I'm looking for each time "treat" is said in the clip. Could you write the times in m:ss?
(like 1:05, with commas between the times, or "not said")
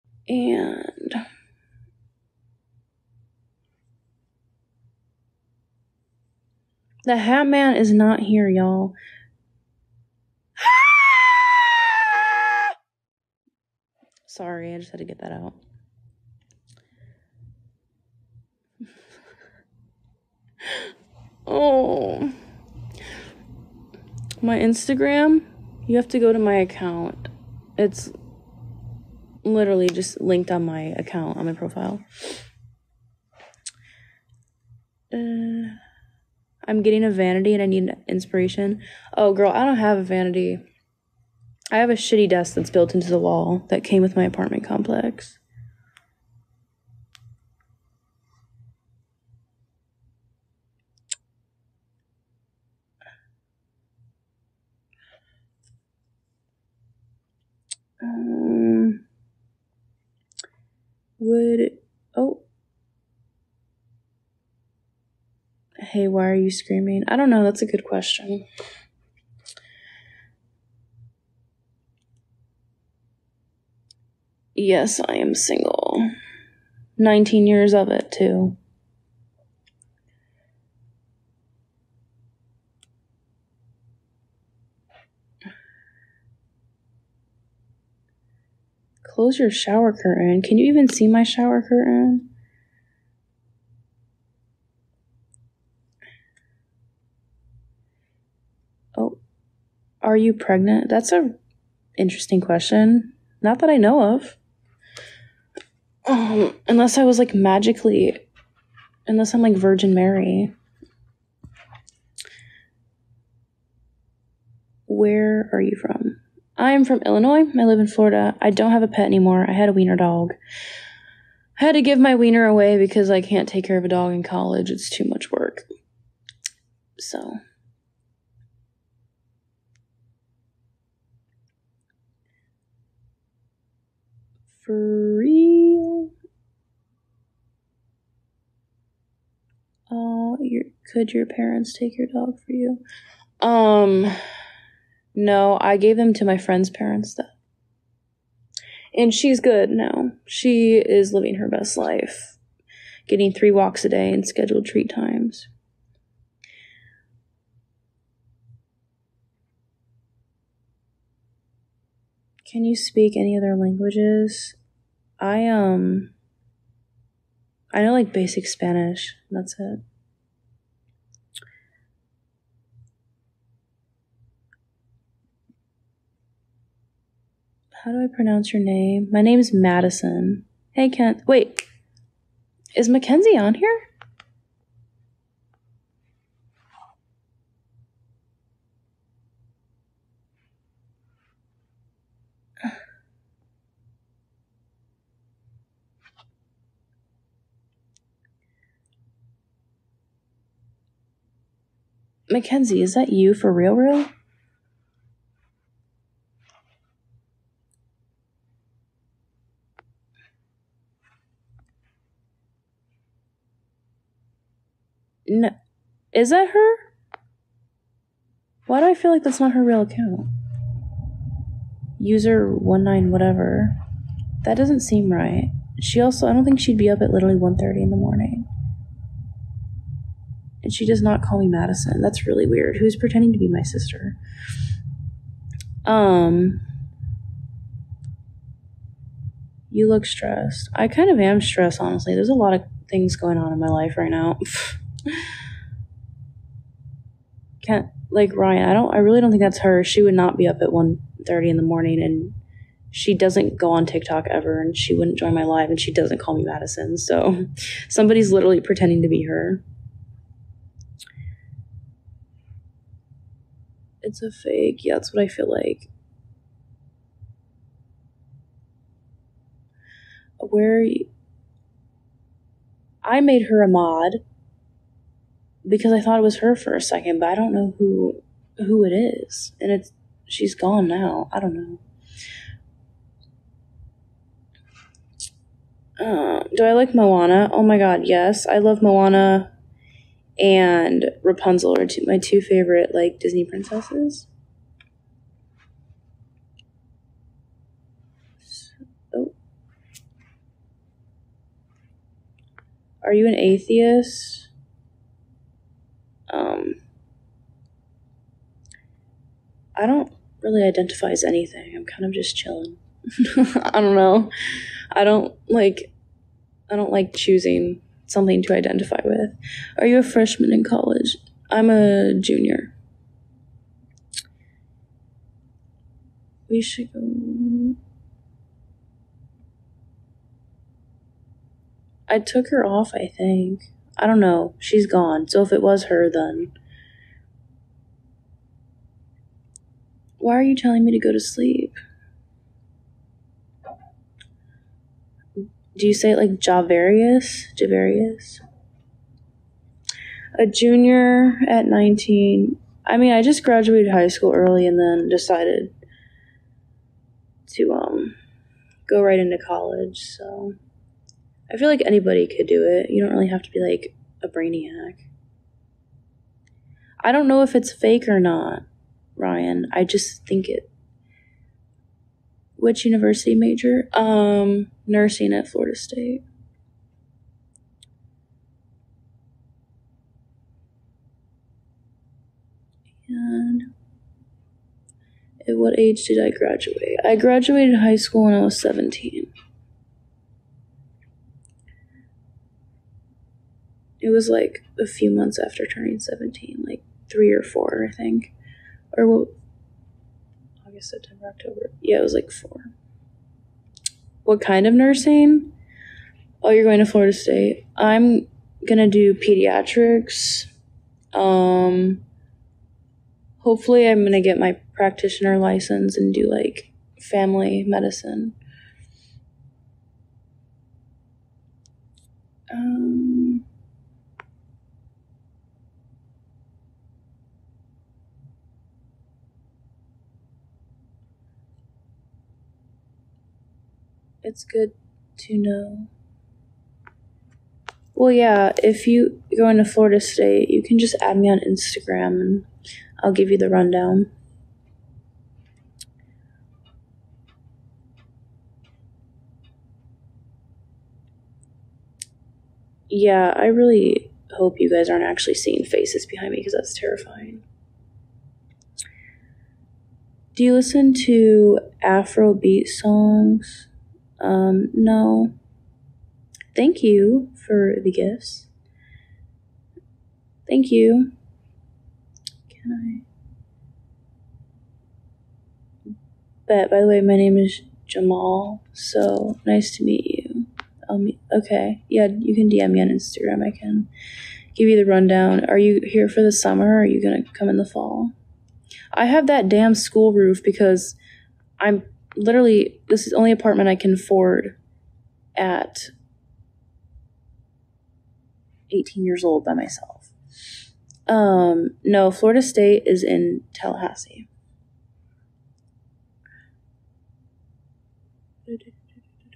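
2:34.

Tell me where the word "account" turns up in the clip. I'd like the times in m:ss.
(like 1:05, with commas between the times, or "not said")
0:26, 0:30, 3:39.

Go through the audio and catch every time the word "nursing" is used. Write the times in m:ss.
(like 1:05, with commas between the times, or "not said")
6:14, 6:44.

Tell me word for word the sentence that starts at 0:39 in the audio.
Oh, girl, I don't have a vanity.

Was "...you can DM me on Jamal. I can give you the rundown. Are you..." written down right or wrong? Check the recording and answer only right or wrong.
wrong.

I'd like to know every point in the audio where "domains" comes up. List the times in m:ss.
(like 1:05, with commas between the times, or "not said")
not said.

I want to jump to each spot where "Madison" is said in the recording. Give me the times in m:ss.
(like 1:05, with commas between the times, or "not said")
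2:59, 3:51, 4:16.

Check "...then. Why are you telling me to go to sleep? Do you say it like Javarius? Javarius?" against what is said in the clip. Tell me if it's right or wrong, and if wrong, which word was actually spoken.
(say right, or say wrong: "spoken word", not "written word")
right.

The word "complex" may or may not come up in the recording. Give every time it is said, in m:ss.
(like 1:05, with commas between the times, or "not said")
0:44.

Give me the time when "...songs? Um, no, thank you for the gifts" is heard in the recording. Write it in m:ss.
7:42.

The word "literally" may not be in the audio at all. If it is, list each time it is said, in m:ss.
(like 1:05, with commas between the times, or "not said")
0:29, 3:47, 4:18, 8:12.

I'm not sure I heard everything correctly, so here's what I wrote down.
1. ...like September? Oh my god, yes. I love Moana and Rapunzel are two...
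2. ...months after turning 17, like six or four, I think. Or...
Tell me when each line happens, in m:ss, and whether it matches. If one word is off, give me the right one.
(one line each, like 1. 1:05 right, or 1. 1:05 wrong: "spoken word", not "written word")
1. 4:46 wrong: "Moana", not "September"
2. 6:35 wrong: "three", not "six".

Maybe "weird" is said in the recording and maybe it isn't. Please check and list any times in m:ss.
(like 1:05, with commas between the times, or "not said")
3:52.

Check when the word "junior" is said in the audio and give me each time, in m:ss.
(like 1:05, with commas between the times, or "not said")
5:22, 5:50.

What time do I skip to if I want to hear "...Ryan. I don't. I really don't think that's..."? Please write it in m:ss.
4:08.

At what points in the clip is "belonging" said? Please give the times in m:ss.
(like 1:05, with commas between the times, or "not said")
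not said.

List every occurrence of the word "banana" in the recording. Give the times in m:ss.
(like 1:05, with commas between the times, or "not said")
not said.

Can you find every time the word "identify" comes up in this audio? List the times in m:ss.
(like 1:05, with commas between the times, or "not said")
5:10, 5:18.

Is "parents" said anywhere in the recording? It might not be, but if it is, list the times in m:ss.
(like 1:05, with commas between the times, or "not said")
2:21, 2:26.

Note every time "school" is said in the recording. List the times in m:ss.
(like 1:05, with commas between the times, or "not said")
5:54, 6:27, 8:09.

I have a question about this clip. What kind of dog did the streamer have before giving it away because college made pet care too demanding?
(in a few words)
wiener dog.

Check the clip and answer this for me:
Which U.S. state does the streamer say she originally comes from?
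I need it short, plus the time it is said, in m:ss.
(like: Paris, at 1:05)
Illinois, at 1:57.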